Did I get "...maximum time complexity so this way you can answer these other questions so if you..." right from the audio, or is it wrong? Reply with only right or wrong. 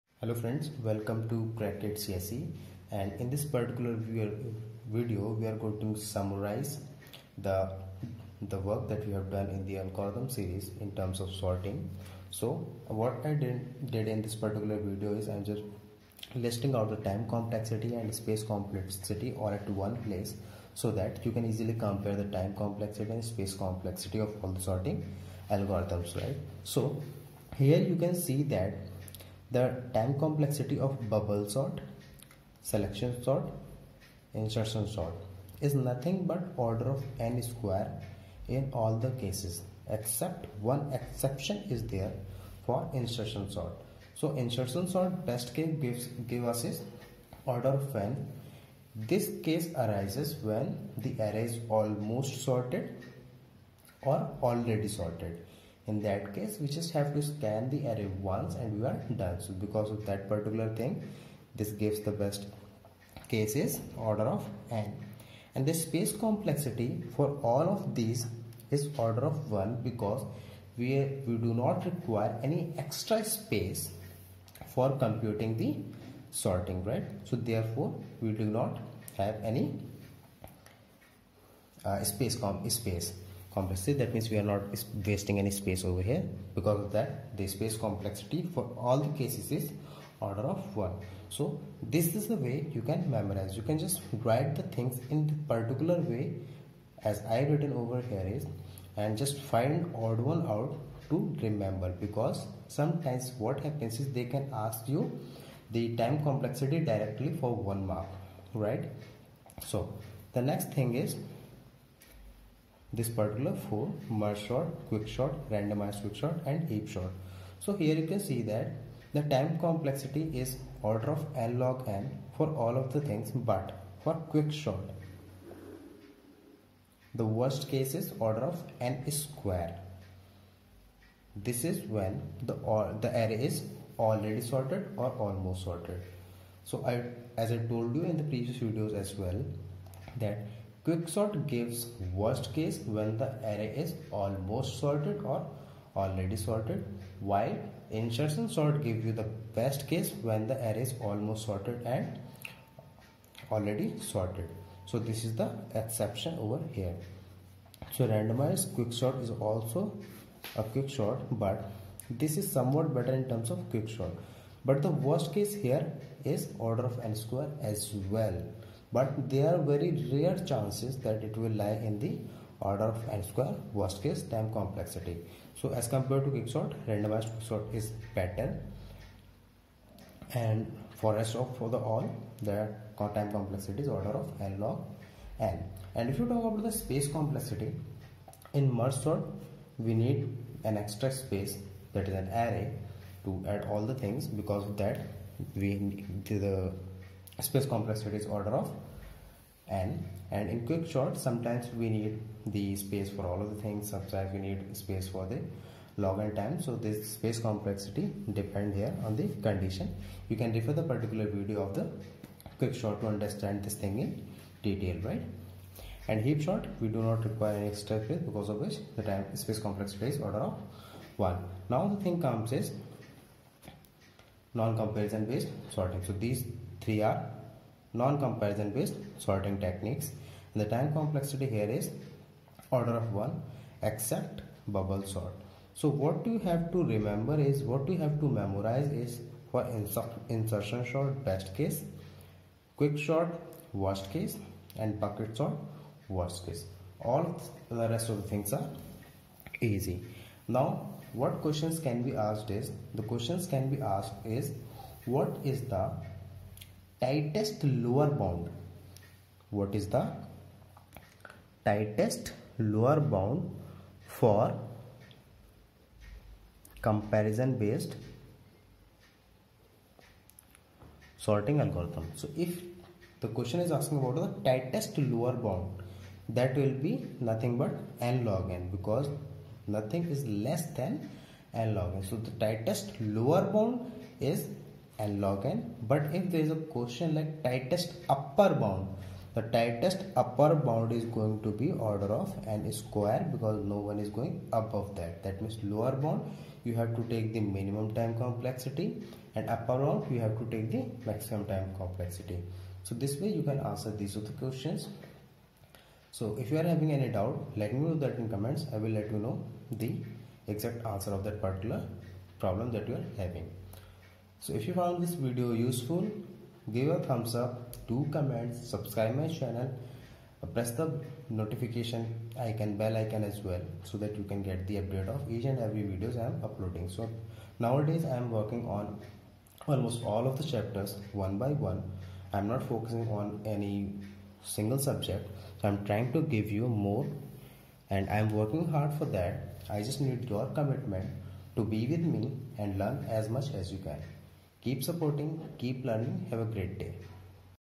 right.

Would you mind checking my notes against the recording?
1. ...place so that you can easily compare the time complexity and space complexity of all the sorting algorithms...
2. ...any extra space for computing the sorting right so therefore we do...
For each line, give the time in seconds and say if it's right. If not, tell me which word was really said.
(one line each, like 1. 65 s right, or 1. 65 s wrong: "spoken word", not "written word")
1. 20 s right
2. 72 s right.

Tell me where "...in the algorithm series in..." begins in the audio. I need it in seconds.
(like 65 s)
9 s.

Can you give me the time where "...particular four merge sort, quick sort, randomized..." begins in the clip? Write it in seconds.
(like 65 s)
113 s.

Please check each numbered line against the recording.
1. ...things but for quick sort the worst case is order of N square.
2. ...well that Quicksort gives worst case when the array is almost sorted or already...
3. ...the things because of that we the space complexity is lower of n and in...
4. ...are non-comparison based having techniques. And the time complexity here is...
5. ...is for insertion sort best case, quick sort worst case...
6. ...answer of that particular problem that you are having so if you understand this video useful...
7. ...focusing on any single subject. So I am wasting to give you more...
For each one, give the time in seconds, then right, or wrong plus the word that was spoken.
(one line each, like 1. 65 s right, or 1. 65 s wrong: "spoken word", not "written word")
1. 123 s right
2. 139 s right
3. 193 s wrong: "order", not "lower"
4. 227 s wrong: "sorting", not "having"
5. 238 s right
6. 310 s wrong: "found", not "understand"
7. 332 s wrong: "trying", not "wasting".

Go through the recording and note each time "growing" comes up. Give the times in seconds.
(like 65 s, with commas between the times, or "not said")
not said.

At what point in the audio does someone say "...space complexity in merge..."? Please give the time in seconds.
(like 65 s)
186 s.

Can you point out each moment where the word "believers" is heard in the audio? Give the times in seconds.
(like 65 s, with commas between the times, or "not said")
not said.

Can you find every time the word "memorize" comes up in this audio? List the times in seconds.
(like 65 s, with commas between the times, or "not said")
93 s, 238 s.